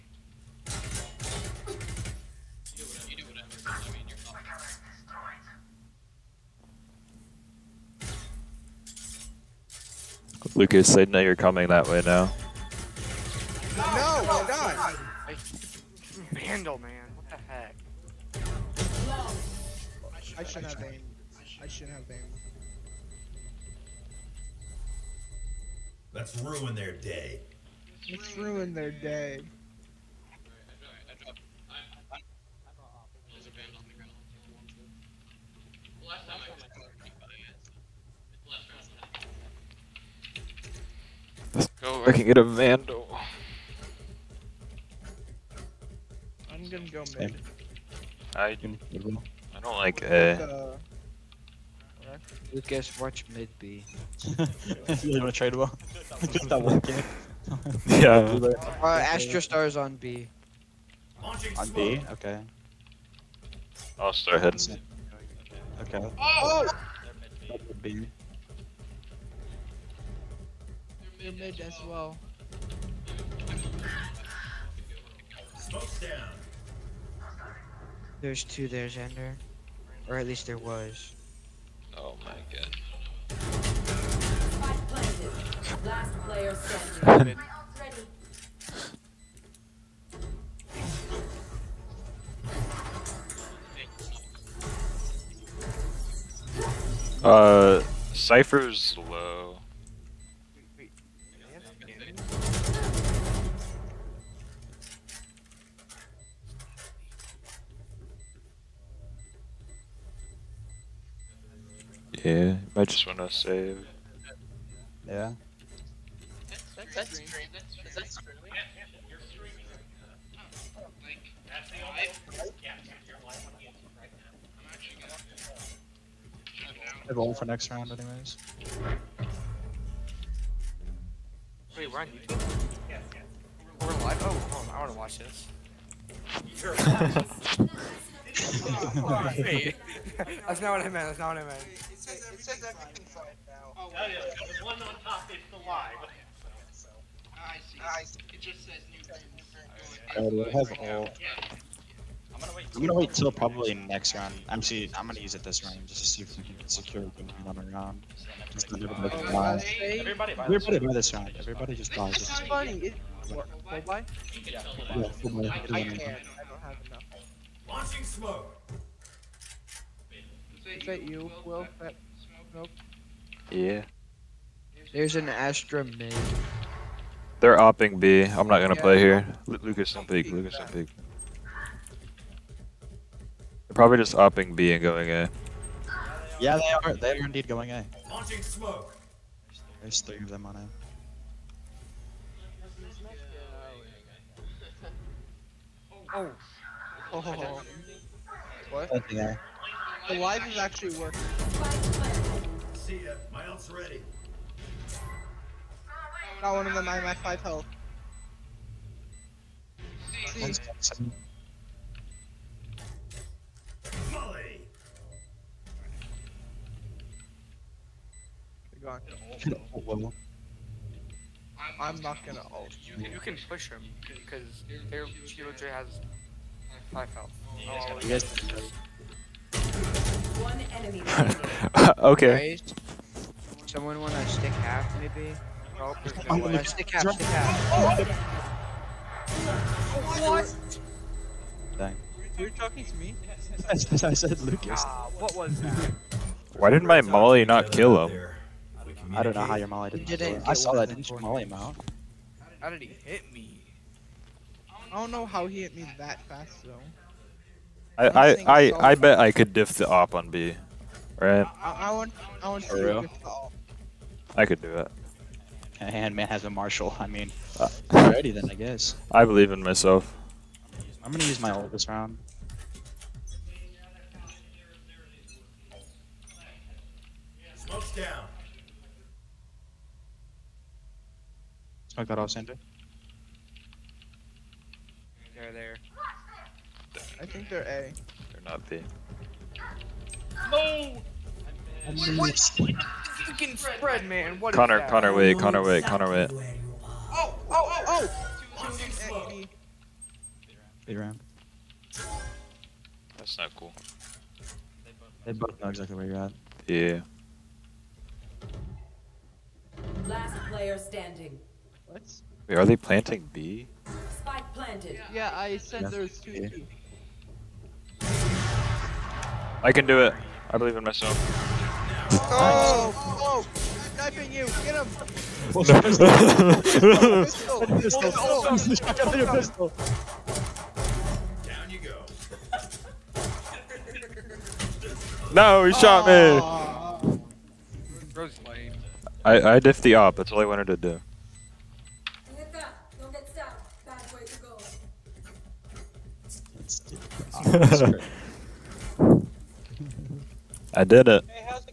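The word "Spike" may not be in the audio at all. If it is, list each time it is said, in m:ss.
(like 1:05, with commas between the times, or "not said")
5:14.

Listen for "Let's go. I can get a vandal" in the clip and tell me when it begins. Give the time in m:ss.
0:41.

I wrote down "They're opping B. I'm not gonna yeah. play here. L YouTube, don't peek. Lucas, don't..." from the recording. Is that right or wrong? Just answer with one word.
wrong.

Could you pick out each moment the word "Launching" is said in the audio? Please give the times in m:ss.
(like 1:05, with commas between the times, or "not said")
2:47, 3:08.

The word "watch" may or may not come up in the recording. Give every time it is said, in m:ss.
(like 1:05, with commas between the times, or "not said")
0:53, 2:14.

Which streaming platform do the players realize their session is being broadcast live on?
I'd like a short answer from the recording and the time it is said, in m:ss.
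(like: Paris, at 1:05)
YouTube, at 2:12.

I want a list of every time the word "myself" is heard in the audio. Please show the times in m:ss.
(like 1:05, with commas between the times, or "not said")
4:29, 5:20.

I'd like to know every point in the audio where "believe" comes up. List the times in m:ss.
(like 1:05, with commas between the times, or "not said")
4:29, 5:20.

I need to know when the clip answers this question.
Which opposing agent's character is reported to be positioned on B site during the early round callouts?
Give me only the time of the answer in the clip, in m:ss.
0:58.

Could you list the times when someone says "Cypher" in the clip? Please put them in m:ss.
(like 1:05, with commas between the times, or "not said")
1:38.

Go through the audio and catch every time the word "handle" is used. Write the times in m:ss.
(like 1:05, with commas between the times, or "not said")
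0:16.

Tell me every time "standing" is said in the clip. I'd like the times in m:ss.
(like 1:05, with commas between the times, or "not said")
1:26, 5:10.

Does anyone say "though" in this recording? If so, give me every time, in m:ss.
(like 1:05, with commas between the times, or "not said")
4:16.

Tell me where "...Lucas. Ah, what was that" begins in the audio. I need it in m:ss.
4:04.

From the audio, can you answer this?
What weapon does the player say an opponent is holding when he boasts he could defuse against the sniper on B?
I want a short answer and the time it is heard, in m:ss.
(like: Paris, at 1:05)
Marshal, at 4:26.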